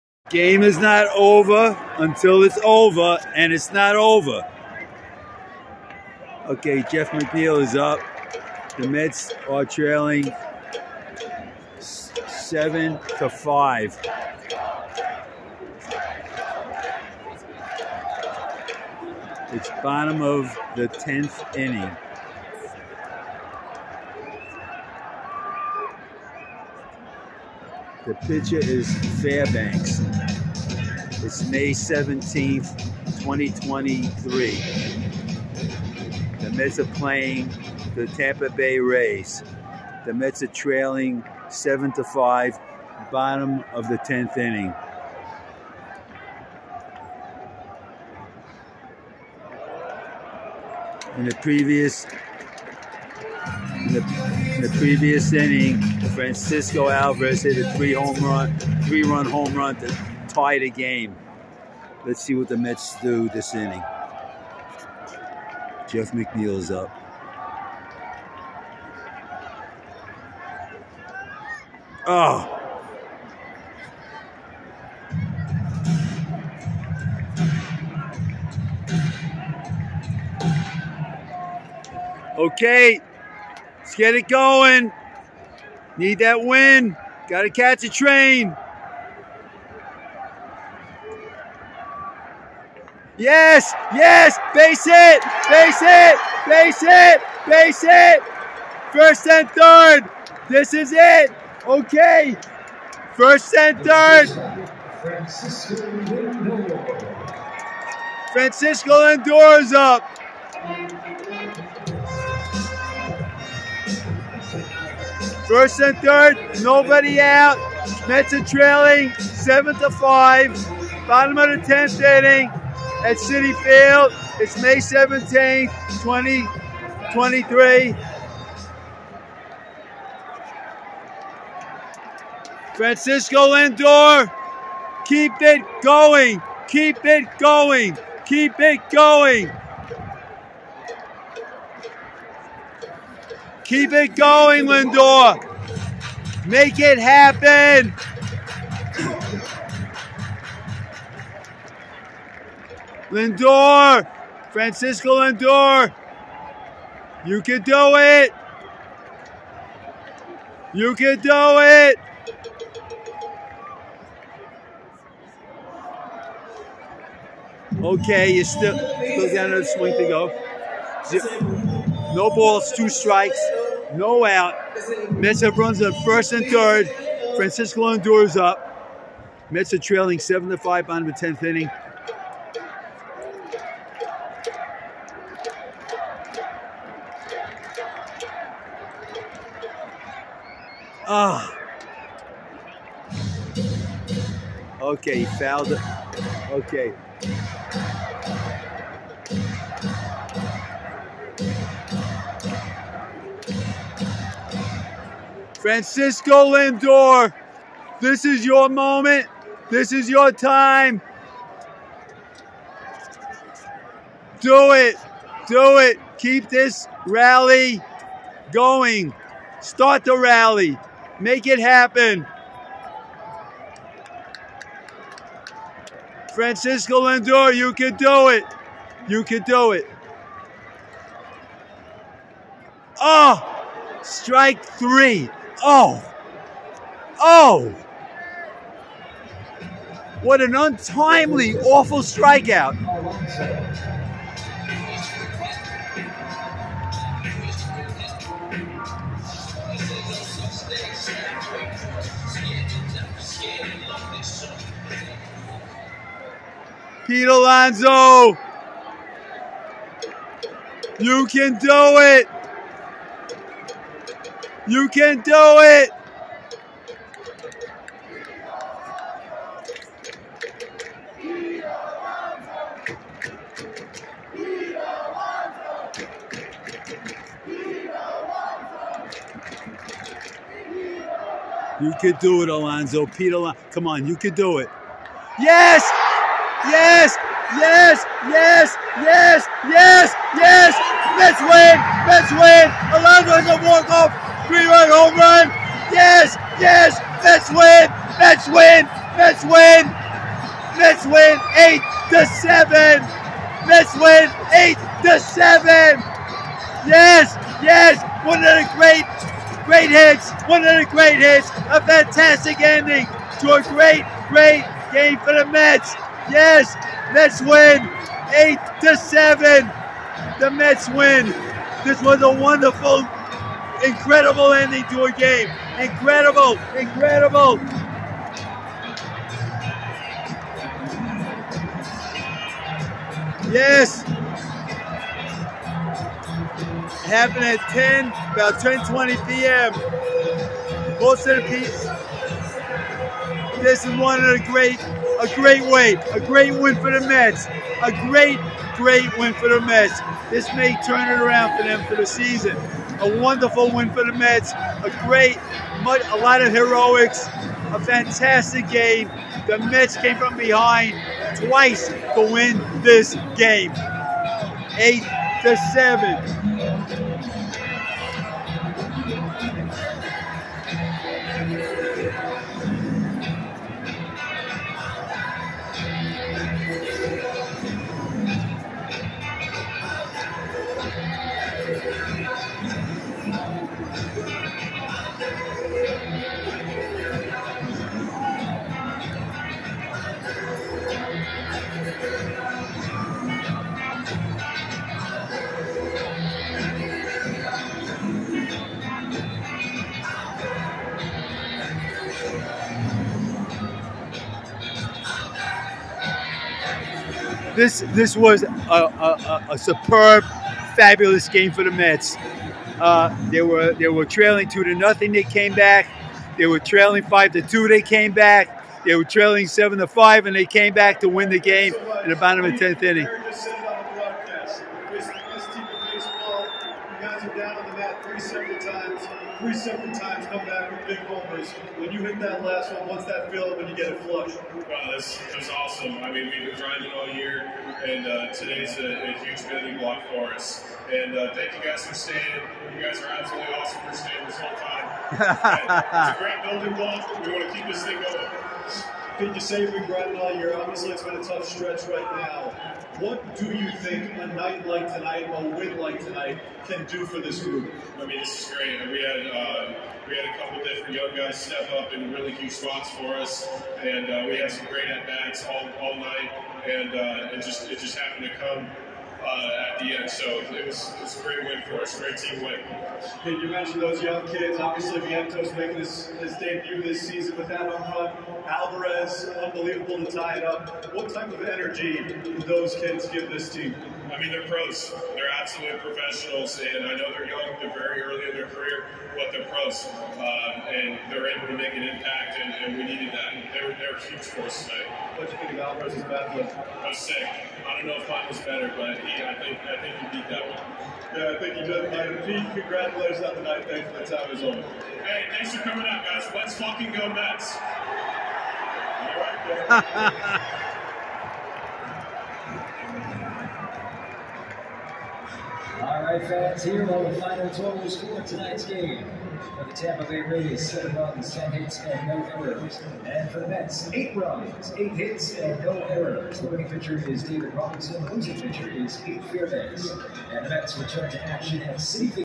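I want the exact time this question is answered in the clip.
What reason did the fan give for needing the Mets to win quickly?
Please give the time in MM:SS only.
01:27.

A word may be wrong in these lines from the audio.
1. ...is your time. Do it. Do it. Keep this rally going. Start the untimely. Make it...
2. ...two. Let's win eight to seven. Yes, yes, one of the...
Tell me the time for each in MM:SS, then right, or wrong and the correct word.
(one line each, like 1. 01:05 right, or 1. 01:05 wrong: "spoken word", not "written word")
1. 03:29 wrong: "rally", not "untimely"
2. 05:02 wrong: "seven", not "two".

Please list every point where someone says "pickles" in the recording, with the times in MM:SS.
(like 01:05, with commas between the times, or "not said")
not said.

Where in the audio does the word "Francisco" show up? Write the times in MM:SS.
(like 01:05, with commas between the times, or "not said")
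00:56, 01:48, 02:12, 02:34, 02:57, 03:25, 03:46.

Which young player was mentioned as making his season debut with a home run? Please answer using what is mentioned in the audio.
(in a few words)
Vientos.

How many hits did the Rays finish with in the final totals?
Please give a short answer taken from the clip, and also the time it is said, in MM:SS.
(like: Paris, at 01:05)
10, at 08:41.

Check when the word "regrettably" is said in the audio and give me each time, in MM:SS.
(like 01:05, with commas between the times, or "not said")
07:29.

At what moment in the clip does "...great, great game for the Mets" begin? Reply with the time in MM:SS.
05:13.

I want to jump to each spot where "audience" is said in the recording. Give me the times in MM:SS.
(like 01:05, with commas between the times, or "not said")
not said.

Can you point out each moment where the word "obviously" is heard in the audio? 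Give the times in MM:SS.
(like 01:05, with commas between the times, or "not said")
07:30, 07:54.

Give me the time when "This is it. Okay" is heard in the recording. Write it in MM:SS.
01:40.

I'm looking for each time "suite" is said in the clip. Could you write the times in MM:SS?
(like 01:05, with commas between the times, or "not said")
not said.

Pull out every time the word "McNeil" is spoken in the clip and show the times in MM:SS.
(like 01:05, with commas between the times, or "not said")
00:07, 01:06.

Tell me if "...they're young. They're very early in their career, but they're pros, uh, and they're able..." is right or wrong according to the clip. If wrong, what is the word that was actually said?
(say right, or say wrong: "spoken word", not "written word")
right.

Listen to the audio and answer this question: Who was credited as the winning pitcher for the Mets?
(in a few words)
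David Robertson.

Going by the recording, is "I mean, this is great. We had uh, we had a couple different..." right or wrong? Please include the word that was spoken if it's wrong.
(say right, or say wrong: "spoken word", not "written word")
right.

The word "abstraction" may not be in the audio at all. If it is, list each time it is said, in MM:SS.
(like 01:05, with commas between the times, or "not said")
not said.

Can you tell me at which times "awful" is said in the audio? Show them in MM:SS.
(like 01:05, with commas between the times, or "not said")
04:01.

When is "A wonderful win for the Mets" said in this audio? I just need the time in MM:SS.
05:52.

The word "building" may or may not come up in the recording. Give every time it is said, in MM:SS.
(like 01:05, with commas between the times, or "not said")
07:19, 07:26.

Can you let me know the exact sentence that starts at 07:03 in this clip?
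Three separate times, three separate when you hit that last one, what's that feel when you get it flush?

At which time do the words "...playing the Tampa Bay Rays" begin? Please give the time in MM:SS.
00:36.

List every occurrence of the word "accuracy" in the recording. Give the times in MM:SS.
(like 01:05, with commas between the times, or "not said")
not said.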